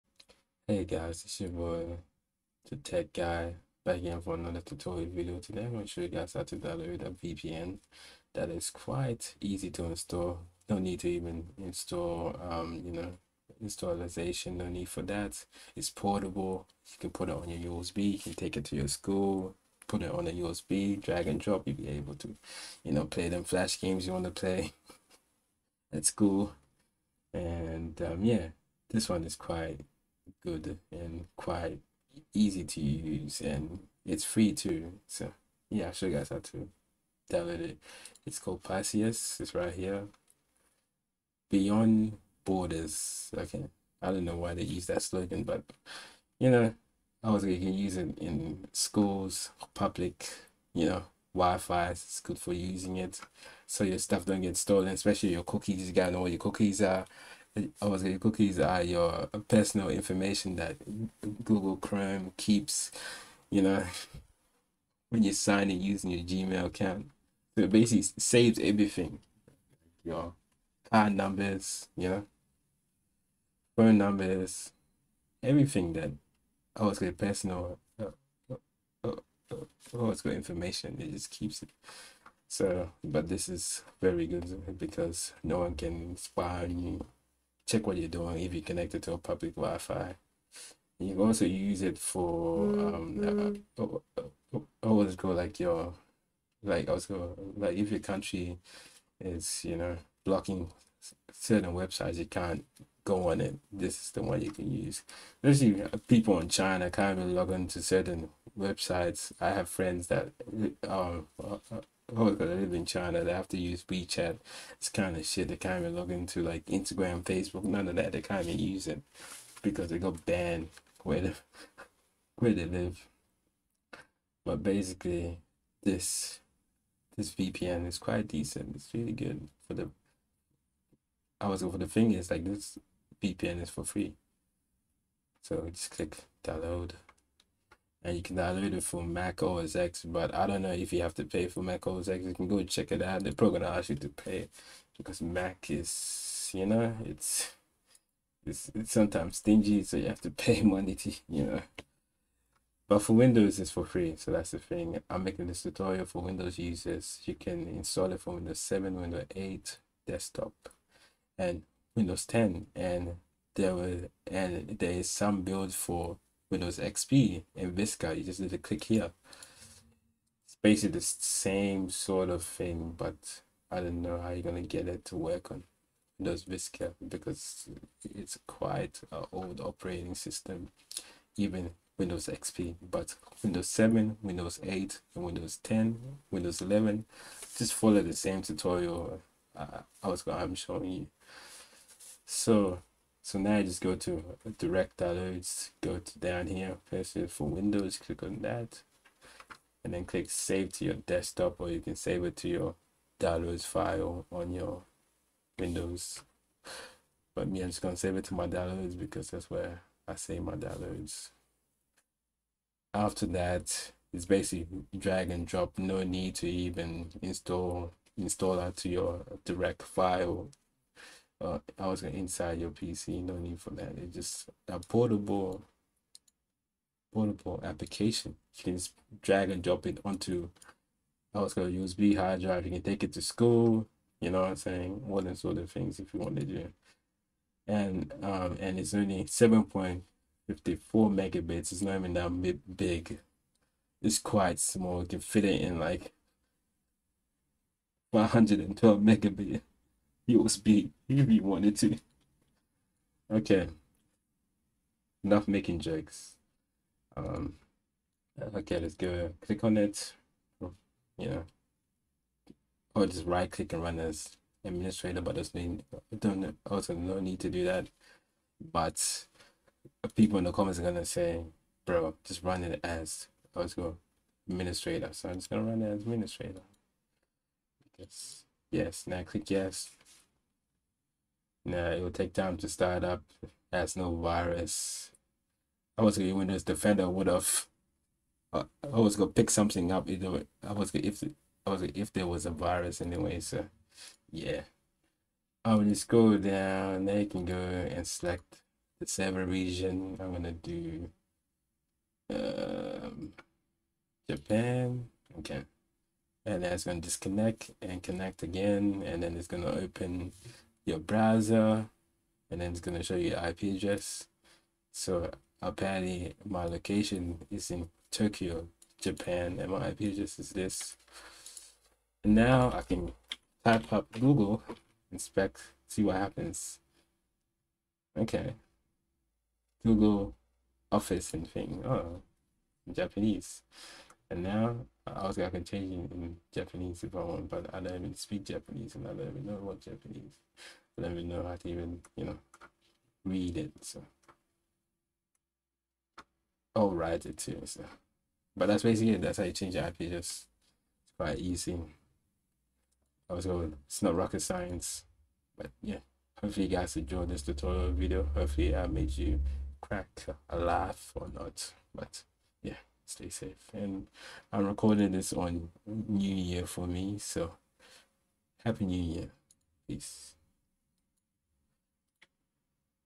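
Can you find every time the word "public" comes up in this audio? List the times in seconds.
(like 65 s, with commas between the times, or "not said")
49 s, 89 s.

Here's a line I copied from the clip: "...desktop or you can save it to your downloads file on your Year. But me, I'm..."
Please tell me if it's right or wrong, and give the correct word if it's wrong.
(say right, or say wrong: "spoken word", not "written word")
wrong: "Windows", not "Year".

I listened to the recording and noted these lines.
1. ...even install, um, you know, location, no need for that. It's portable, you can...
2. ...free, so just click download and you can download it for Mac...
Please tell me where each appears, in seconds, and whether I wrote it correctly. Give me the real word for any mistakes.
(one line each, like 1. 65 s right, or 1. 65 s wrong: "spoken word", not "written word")
1. 11 s wrong: "installation", not "location"
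2. 133 s right.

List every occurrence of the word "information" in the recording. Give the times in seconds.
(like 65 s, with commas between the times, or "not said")
59 s, 80 s.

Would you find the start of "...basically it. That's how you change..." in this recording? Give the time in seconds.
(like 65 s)
348 s.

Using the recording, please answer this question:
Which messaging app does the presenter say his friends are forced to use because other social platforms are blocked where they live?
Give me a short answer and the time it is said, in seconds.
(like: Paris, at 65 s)
WeChat, at 113 s.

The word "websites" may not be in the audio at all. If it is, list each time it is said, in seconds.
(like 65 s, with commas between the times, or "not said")
101 s, 108 s.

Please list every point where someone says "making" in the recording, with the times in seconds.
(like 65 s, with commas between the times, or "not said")
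155 s, 255 s.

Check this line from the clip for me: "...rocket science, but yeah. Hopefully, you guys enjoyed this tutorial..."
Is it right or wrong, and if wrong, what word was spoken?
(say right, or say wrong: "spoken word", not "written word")
right.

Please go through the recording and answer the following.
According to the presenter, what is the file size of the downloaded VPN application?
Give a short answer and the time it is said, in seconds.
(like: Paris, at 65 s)
7.54 megabits, at 239 s.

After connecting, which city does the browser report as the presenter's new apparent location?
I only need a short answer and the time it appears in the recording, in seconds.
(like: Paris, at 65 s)
Tokyo, at 318 s.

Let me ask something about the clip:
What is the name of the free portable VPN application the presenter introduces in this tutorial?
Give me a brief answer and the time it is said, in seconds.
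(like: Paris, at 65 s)
Passius, at 38 s.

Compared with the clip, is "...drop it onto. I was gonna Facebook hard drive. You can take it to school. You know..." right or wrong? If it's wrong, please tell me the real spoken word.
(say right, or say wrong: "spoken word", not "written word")
wrong: "USB", not "Facebook".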